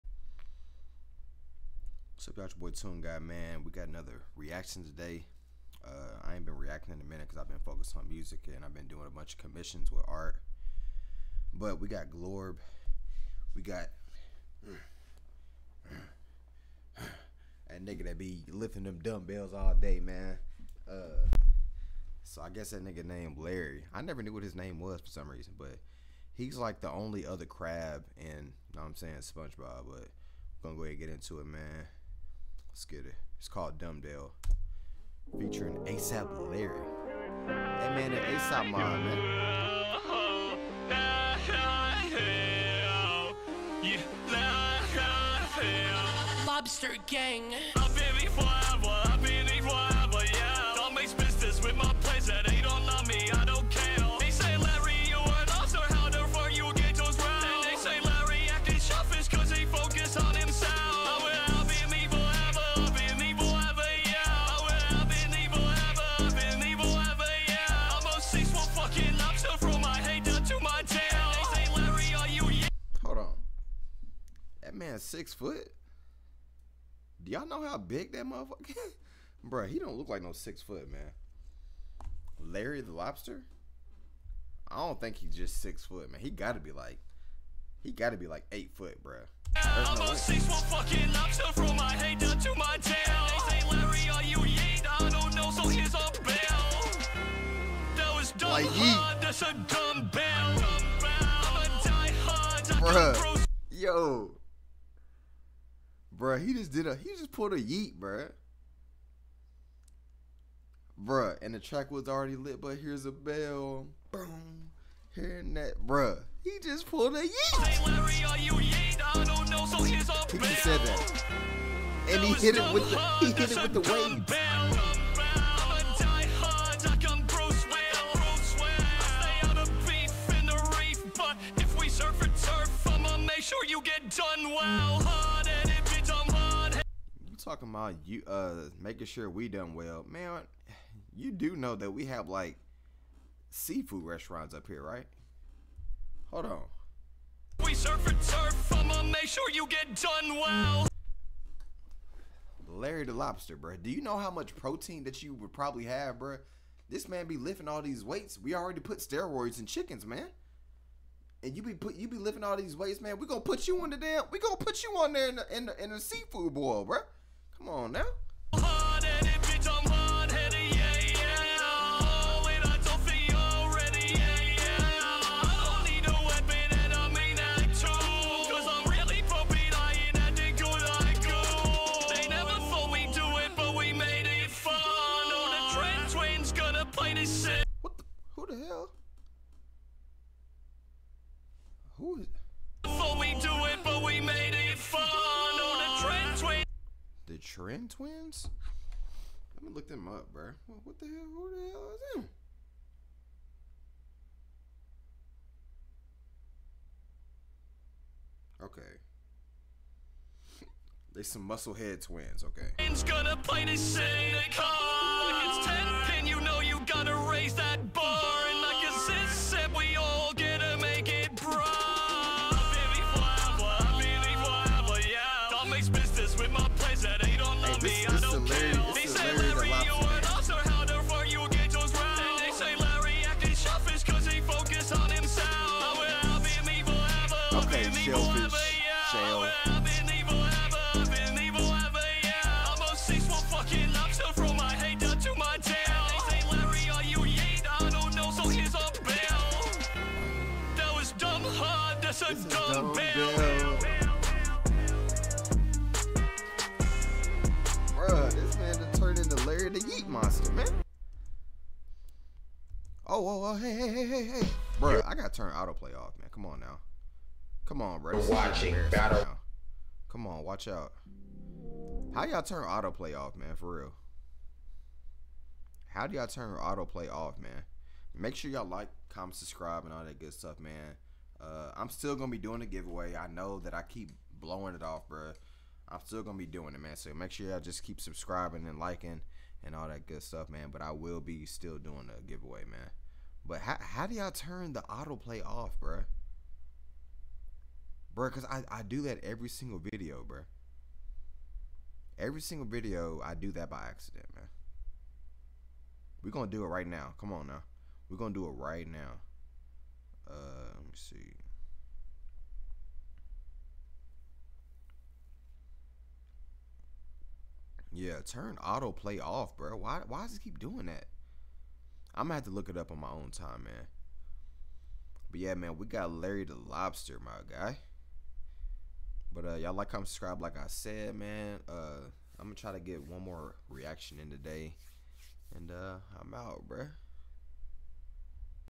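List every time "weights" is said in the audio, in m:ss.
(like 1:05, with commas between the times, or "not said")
2:38, 2:42.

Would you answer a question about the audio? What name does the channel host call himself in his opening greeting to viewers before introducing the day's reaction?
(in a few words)
Tune Guy.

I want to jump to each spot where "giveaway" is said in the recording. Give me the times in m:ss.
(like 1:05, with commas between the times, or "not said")
4:42, 4:52.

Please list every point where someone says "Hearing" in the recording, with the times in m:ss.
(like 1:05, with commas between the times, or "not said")
1:55.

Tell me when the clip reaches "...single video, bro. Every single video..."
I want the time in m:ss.
4:59.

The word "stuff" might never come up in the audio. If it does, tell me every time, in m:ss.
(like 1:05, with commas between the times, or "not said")
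4:40, 4:50.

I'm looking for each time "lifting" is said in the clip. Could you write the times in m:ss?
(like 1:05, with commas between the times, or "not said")
0:18, 2:37, 2:42.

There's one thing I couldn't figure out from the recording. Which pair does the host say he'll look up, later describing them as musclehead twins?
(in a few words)
Trend Twins.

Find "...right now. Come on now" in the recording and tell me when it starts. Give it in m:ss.
5:06.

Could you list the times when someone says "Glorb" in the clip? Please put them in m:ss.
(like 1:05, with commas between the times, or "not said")
0:12.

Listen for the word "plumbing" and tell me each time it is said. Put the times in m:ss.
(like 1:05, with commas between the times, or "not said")
not said.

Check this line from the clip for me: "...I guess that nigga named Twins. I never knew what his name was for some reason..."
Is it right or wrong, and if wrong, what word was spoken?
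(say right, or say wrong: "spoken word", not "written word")
wrong: "Larry", not "Twins".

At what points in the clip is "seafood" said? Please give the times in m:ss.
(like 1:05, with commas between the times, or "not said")
2:23, 2:45.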